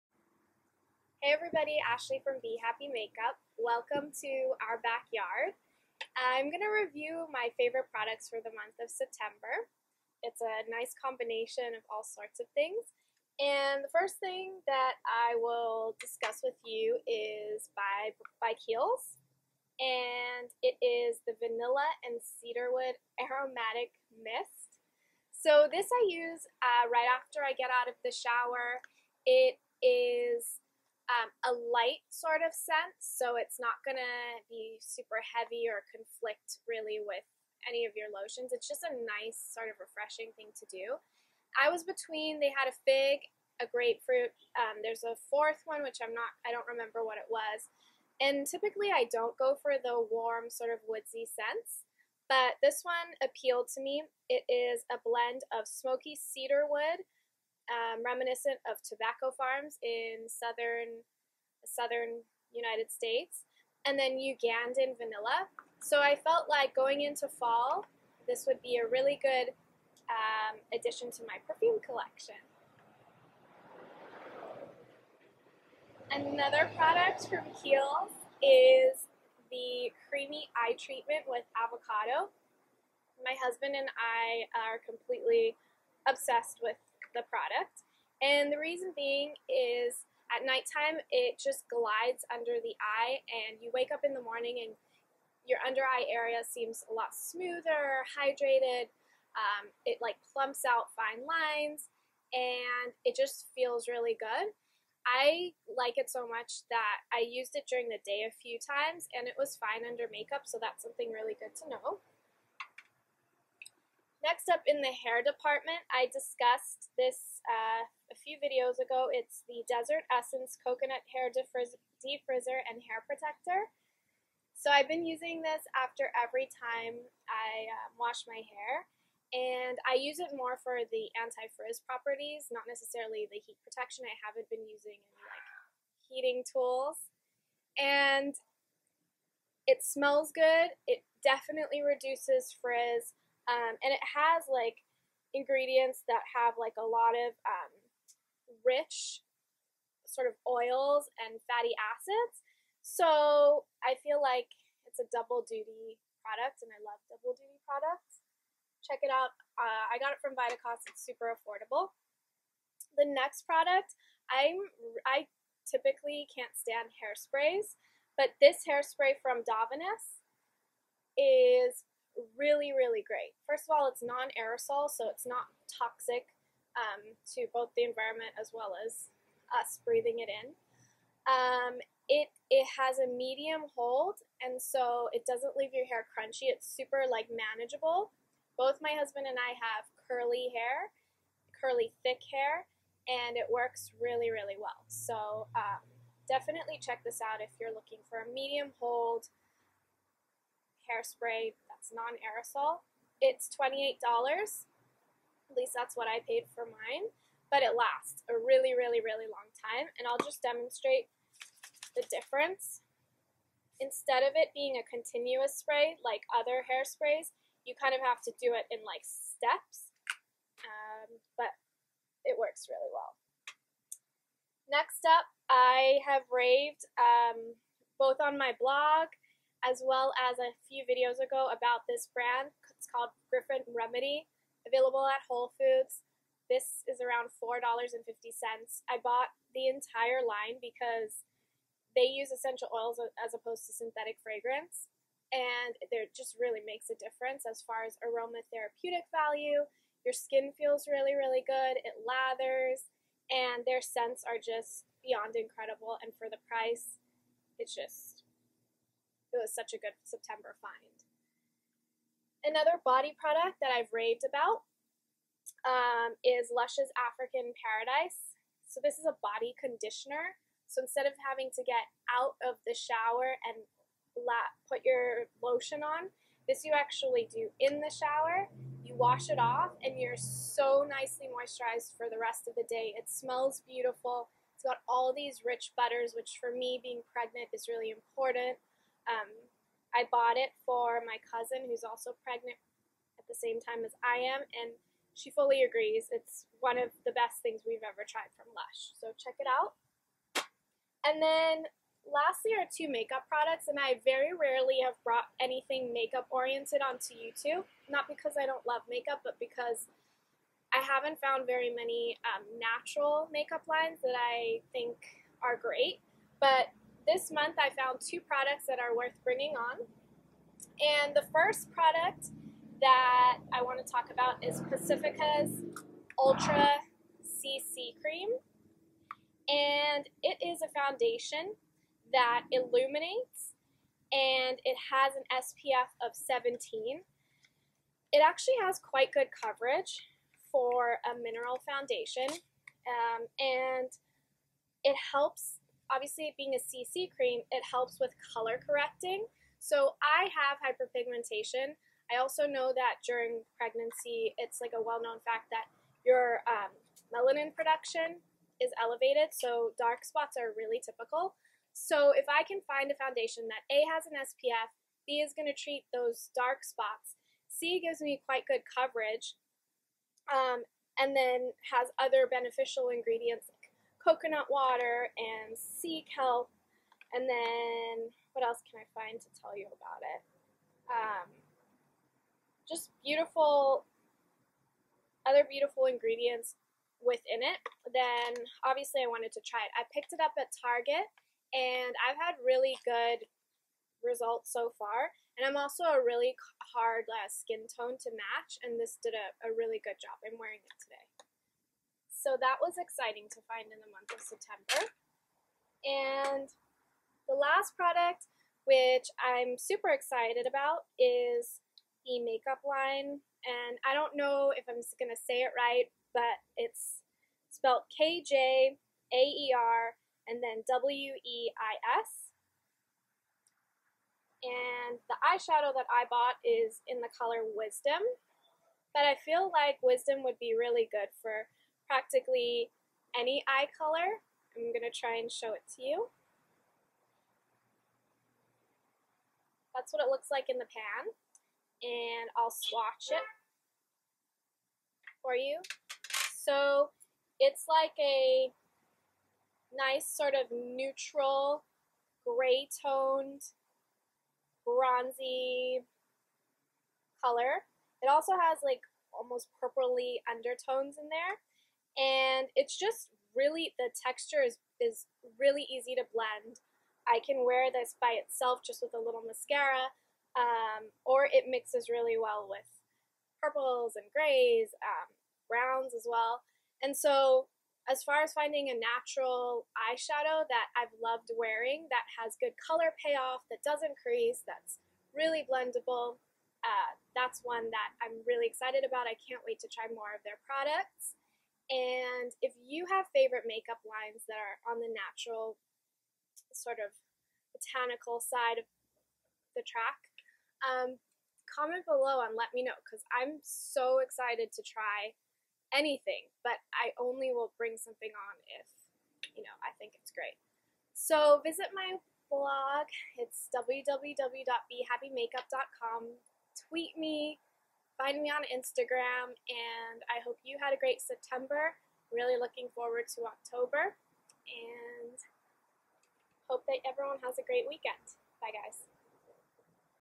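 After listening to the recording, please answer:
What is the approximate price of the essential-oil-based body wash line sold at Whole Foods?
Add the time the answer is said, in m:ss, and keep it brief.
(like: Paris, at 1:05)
$4.50, at 3:57.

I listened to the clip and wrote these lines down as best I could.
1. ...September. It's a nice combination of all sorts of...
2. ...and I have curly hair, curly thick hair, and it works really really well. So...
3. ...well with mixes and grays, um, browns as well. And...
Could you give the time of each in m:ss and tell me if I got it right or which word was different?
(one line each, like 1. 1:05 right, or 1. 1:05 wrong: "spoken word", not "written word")
1. 0:08 right
2. 3:09 right
3. 7:52 wrong: "purples", not "mixes".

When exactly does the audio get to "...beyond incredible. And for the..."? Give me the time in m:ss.
4:15.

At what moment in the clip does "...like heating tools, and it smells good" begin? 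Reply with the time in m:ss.
2:15.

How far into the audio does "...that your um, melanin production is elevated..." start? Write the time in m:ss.
5:55.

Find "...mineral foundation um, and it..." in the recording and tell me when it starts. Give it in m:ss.
5:41.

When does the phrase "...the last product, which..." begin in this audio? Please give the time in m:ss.
6:47.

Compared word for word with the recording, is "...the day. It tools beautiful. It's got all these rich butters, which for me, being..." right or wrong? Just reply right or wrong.
wrong.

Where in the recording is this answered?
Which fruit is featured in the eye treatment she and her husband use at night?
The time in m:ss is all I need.
1:21.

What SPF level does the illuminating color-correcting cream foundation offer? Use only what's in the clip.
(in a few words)
17.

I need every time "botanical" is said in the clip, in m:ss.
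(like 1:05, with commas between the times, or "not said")
8:17.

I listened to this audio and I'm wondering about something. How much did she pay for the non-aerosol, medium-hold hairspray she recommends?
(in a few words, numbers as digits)
$28.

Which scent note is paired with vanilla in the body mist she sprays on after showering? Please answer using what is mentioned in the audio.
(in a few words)
Cedarwood.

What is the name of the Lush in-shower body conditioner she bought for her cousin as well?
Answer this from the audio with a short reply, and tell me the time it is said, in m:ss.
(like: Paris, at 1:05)
African Paradise, at 4:26.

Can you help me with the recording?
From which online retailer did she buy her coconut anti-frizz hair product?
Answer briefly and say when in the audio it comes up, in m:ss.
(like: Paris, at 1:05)
Vitacost, at 2:40.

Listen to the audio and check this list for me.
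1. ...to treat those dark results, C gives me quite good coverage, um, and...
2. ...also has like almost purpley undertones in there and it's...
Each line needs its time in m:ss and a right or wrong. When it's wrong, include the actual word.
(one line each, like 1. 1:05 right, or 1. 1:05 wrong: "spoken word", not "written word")
1. 6:05 wrong: "spots", not "results"
2. 7:38 right.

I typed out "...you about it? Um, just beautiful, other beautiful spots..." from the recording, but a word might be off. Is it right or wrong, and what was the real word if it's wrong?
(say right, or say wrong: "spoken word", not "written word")
wrong: "ingredients", not "spots".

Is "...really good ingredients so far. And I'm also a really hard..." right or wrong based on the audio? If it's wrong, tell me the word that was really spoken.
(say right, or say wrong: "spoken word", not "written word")
wrong: "results", not "ingredients".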